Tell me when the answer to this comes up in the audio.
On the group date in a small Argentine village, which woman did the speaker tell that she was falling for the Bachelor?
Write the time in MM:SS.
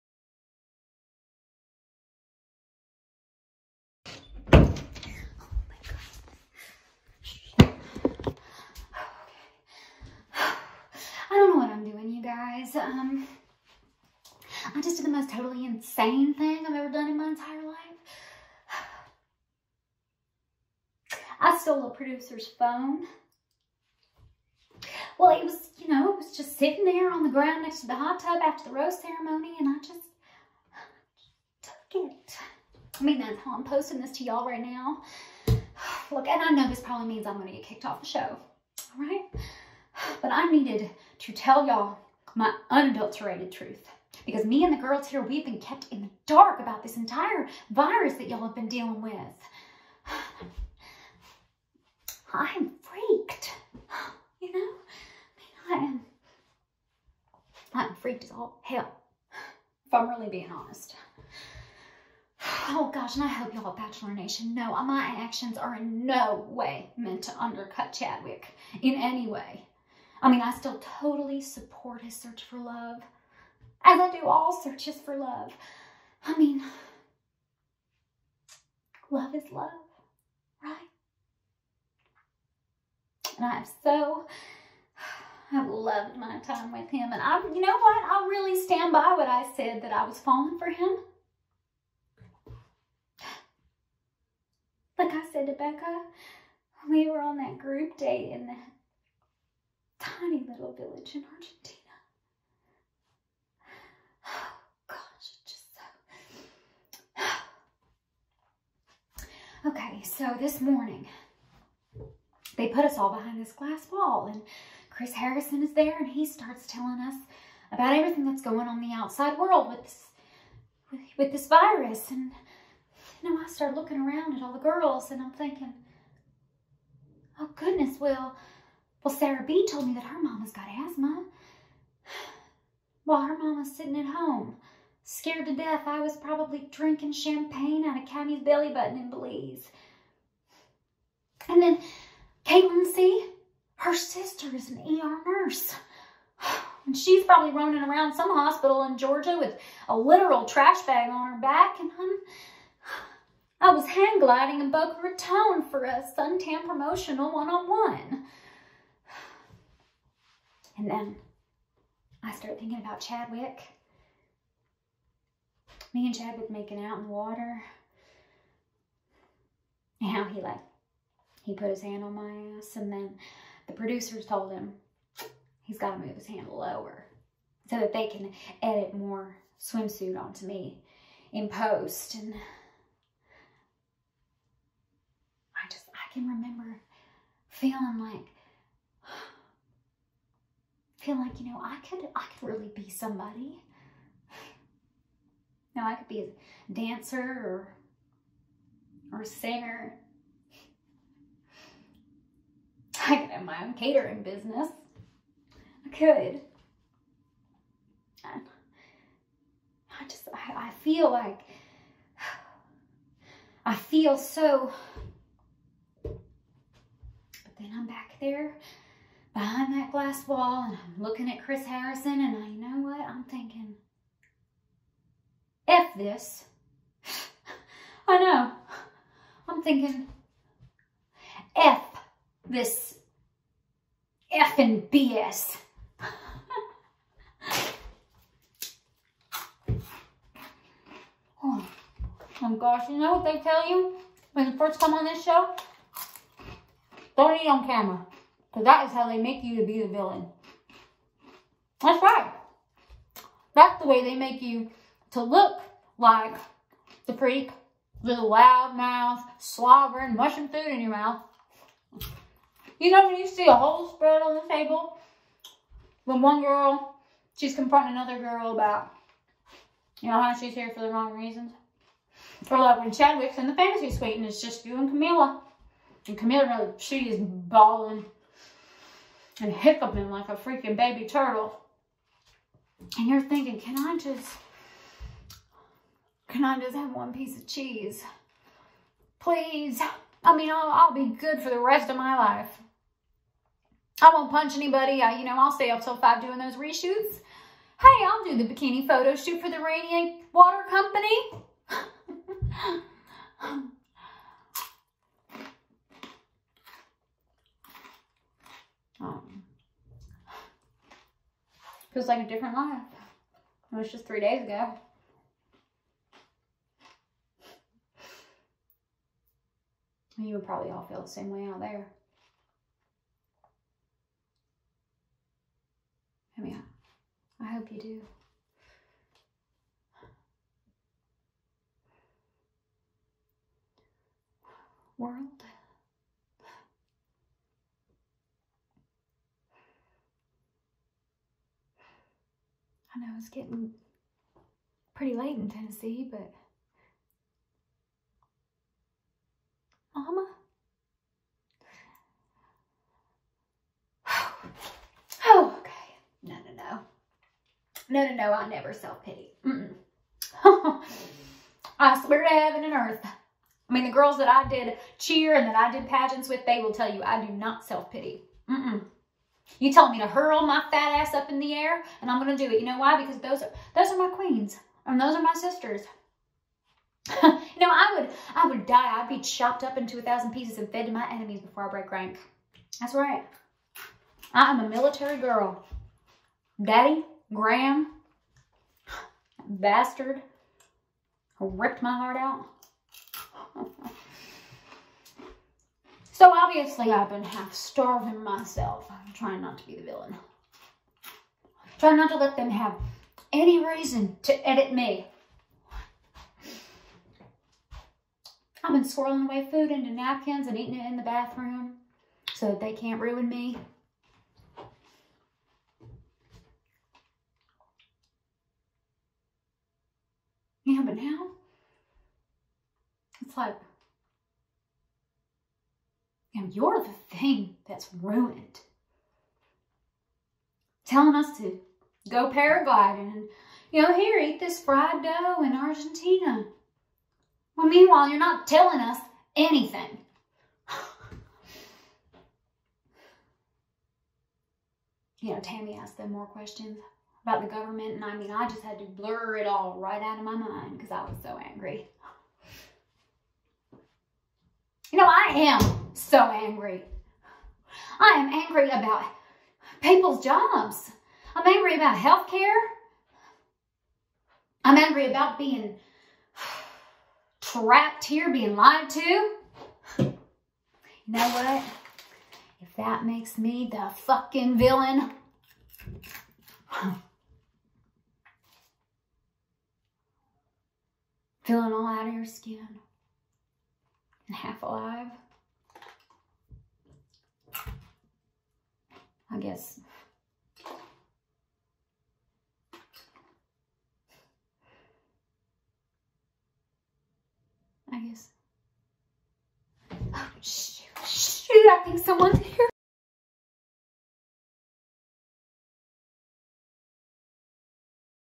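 01:35.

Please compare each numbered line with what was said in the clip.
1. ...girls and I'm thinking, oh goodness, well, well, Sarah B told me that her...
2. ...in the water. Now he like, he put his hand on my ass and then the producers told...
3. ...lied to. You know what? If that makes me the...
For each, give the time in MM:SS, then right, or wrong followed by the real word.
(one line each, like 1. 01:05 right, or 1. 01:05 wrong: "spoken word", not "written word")
1. 02:04 right
2. 02:46 right
3. 07:48 right.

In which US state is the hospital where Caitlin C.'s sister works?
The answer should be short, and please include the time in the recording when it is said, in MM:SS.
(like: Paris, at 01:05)
Georgia, at 02:28.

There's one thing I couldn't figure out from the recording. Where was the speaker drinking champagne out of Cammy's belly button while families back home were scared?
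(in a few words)
Belize.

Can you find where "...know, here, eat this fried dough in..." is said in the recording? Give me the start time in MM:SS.
07:13.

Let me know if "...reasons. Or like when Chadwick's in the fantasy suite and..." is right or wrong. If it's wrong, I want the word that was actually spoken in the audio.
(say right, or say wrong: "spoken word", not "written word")
right.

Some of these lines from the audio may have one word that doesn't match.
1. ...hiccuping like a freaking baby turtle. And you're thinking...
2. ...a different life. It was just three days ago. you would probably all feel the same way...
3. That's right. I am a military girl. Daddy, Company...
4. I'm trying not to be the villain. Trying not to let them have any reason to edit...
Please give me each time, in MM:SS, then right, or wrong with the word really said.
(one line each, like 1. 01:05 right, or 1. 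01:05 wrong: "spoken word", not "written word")
1. 04:39 right
2. 05:12 right
3. 06:22 wrong: "Graham", not "Company"
4. 06:38 right.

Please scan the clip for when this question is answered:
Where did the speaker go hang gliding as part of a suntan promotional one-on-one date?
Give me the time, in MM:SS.
02:34.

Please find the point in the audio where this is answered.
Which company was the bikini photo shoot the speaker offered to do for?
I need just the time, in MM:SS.
04:59.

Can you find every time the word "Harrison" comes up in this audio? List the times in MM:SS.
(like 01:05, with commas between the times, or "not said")
01:55, 03:41.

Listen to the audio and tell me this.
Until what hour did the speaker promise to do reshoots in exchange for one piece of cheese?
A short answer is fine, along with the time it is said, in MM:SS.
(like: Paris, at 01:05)
5, at 04:55.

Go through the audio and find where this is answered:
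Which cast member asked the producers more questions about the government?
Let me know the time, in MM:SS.
07:25.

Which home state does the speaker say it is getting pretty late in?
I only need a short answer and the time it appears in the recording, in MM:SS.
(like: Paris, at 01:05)
Tennessee, at 05:45.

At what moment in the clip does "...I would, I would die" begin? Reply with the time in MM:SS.
06:17.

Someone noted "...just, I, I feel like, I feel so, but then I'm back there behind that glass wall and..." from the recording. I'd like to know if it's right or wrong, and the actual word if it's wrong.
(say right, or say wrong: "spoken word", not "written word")
right.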